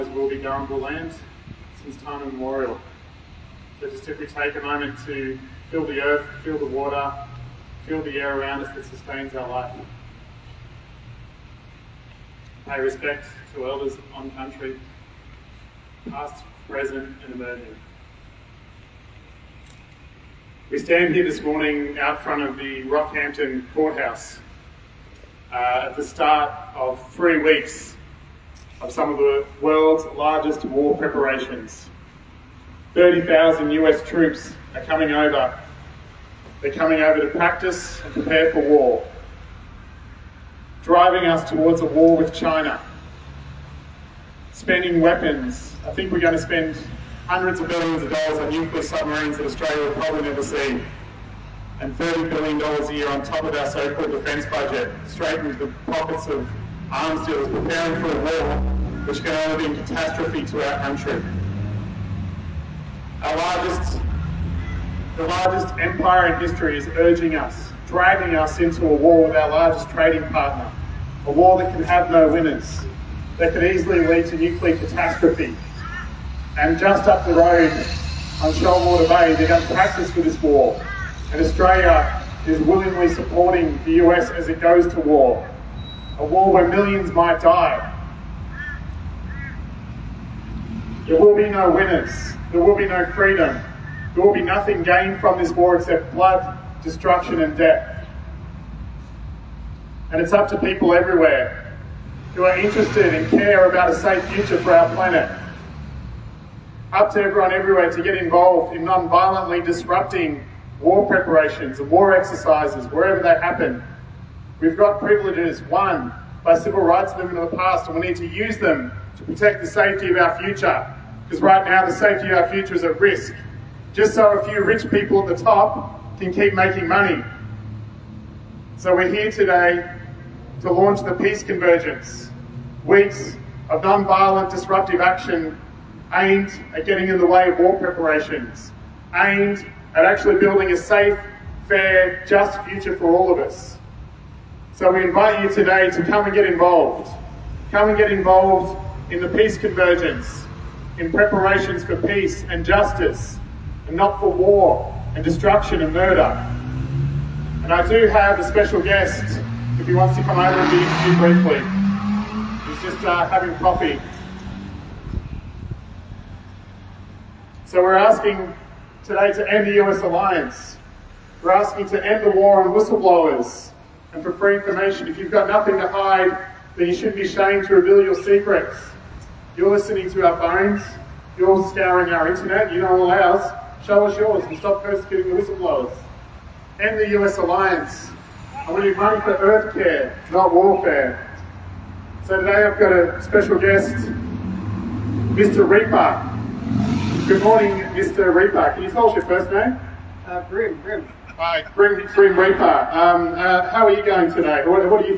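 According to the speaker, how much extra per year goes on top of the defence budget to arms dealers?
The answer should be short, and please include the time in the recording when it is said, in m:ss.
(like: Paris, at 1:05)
$30 billion, at 0:51.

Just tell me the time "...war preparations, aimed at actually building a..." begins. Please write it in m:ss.
2:17.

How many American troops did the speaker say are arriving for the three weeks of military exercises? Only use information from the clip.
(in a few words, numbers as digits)
30,000.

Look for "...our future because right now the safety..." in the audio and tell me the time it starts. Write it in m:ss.
2:00.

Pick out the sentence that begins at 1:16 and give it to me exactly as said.
And just up the road on Shoalwater Bay, they're going to practice for this war.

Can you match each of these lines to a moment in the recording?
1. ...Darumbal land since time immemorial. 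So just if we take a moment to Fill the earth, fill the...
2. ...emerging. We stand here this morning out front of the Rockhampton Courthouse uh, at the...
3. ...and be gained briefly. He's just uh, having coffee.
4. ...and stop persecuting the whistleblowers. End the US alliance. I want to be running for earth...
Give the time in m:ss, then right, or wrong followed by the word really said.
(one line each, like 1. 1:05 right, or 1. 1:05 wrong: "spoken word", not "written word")
1. 0:00 right
2. 0:17 right
3. 2:40 wrong: "interviewed", not "gained"
4. 3:04 right.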